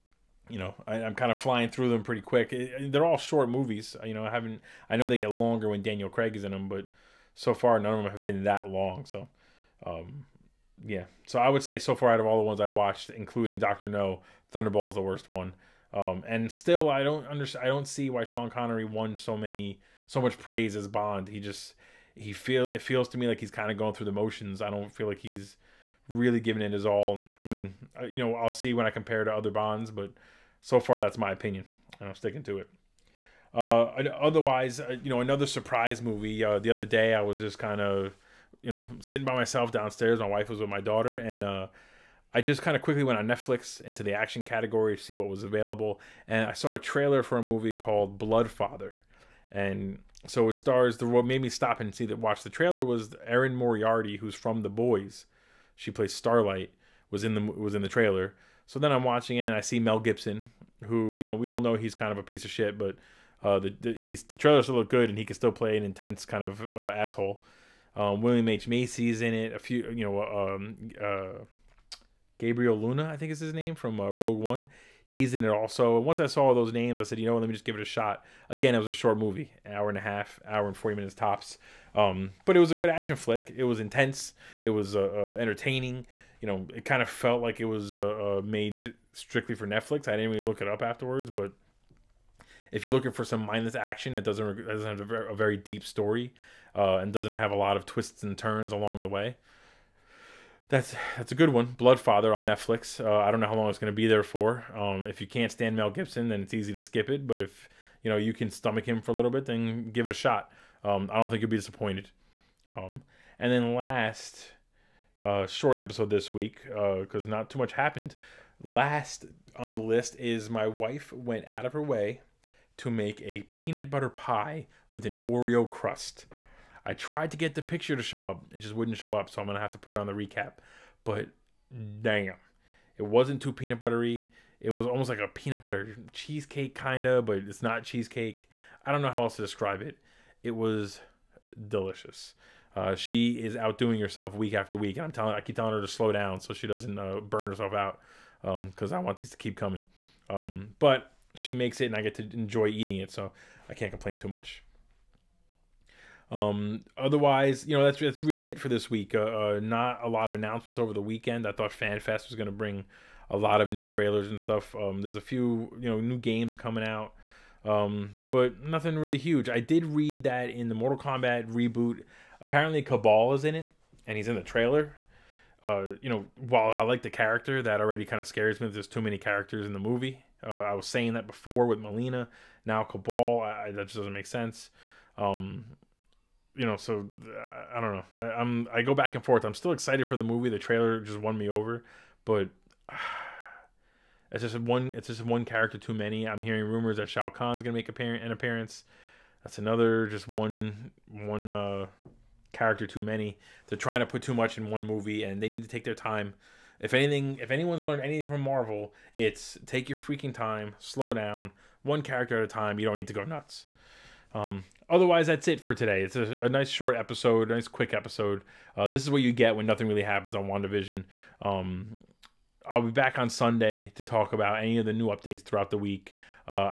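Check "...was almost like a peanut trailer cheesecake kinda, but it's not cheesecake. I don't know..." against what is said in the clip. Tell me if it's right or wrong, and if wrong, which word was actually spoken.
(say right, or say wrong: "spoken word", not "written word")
wrong: "butter", not "trailer".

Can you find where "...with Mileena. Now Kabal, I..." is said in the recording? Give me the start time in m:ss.
3:01.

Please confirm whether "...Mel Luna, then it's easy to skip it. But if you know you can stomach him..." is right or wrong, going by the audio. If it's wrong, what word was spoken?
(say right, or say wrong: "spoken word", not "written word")
wrong: "Gibson", not "Luna".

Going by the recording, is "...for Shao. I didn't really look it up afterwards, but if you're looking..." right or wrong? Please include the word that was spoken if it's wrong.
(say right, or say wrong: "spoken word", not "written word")
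wrong: "Netflix", not "Shao".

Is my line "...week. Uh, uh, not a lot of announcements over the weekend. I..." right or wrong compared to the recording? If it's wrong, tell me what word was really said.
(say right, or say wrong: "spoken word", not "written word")
right.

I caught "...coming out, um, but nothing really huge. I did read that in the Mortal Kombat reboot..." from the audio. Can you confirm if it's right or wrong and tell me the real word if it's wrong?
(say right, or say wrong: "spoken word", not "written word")
right.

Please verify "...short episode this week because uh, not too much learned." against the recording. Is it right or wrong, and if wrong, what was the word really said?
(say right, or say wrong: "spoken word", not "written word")
wrong: "happened", not "learned".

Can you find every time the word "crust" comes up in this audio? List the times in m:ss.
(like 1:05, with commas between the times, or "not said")
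2:05.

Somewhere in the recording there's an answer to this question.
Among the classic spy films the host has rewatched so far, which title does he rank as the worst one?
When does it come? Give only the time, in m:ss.
0:14.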